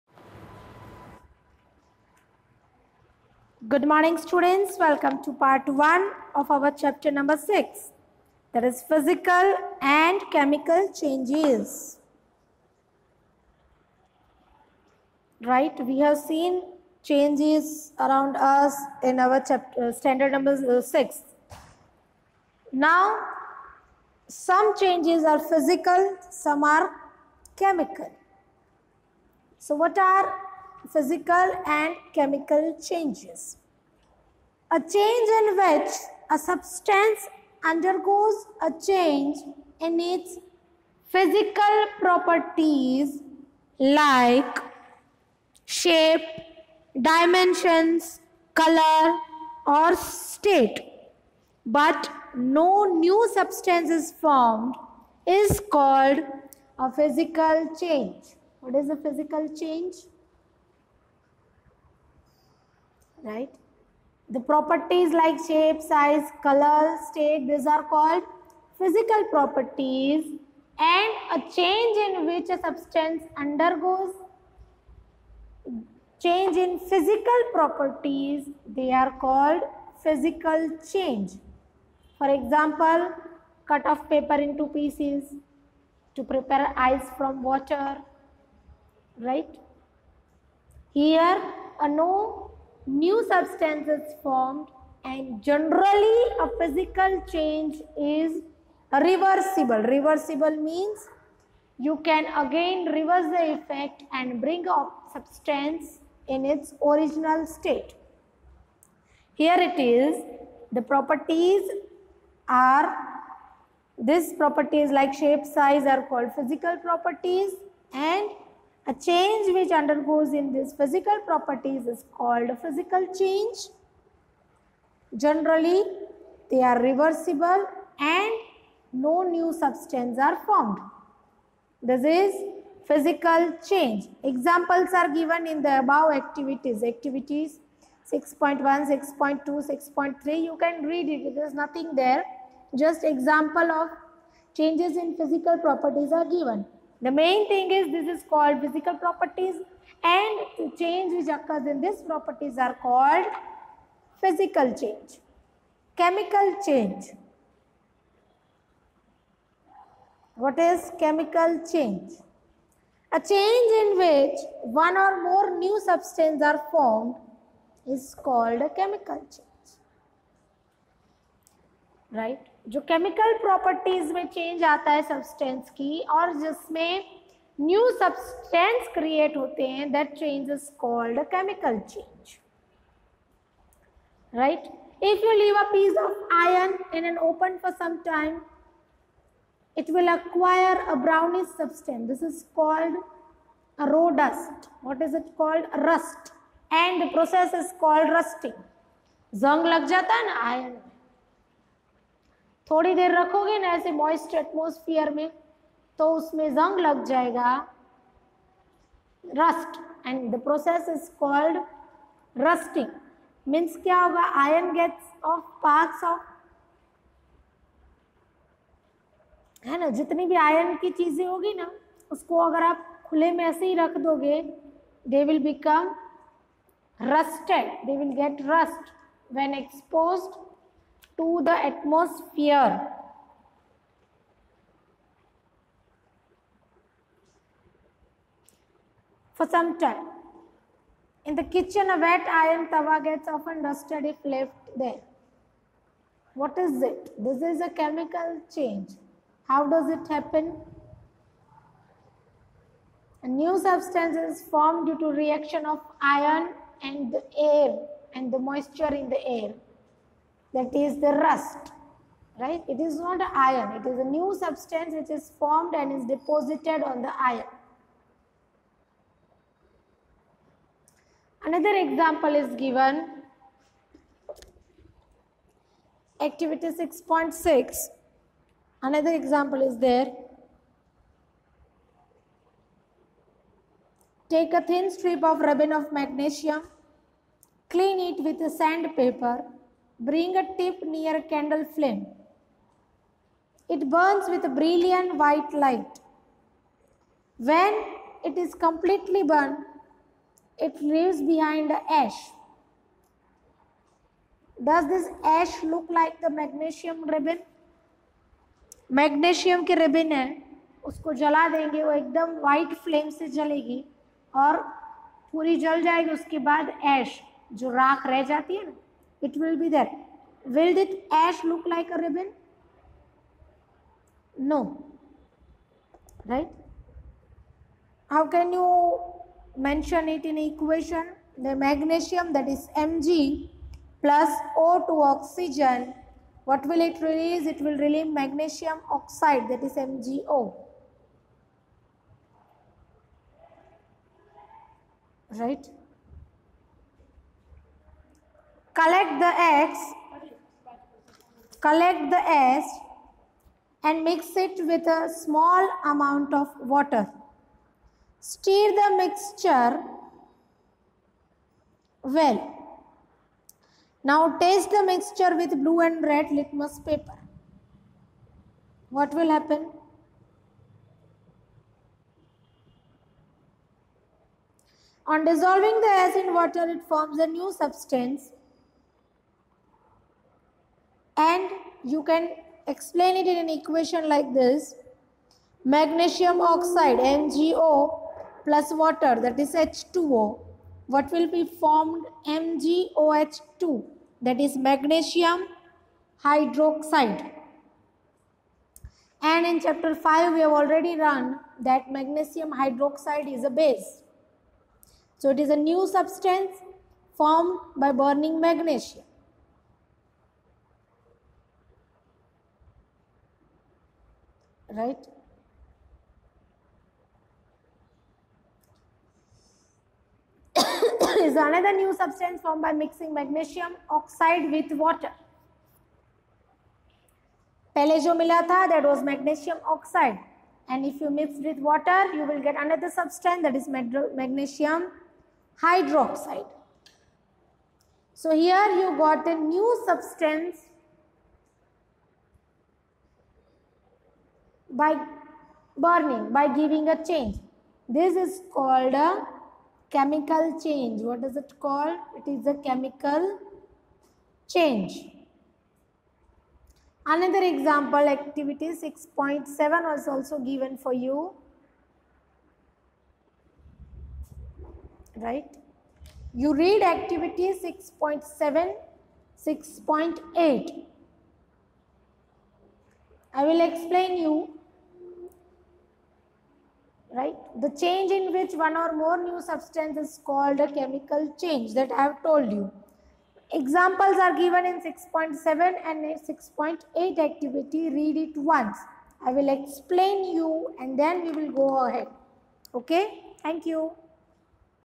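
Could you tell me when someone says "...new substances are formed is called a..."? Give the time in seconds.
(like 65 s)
165 s.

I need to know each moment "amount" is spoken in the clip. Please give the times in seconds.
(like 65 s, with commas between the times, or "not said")
355 s.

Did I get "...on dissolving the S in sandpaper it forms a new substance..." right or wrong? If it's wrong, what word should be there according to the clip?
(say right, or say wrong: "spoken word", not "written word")
wrong: "water", not "sandpaper".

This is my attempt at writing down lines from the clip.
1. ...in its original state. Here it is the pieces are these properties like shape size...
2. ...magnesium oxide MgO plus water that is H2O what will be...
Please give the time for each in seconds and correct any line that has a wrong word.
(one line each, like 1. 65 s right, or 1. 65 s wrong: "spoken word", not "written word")
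1. 106 s wrong: "properties", not "pieces"
2. 385 s right.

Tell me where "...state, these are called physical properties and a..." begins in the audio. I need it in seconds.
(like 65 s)
67 s.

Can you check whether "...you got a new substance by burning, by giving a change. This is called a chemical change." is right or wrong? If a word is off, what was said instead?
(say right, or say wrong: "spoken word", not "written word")
right.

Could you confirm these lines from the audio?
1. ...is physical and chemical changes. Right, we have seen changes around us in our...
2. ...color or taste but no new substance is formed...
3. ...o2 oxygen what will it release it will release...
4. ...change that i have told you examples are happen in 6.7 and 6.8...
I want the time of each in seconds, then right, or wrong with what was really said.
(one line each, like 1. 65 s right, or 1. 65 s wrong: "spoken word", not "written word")
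1. 8 s right
2. 48 s wrong: "state", not "taste"
3. 334 s right
4. 481 s wrong: "given", not "happen".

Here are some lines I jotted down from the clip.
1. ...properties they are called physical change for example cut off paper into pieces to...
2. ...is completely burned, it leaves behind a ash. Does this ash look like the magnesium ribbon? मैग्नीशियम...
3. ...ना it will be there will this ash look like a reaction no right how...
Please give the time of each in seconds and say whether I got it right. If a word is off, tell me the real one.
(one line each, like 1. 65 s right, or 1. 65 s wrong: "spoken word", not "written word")
1. 77 s right
2. 298 s right
3. 318 s wrong: "ribbon", not "reaction".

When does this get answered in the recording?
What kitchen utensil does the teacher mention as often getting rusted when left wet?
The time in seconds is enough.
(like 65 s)
242 s.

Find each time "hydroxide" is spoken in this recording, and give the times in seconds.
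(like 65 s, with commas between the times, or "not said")
396 s, 402 s, 435 s.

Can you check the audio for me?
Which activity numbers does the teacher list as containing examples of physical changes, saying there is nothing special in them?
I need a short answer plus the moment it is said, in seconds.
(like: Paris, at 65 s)
6.1, 6.2, 6.3, at 136 s.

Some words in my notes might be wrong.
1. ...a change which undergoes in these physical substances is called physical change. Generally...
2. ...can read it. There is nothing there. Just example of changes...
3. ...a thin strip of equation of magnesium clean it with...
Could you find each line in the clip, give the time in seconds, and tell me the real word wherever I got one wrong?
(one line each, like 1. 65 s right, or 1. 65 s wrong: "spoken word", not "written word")
1. 118 s wrong: "properties", not "substances"
2. 140 s right
3. 284 s wrong: "ribbon", not "equation".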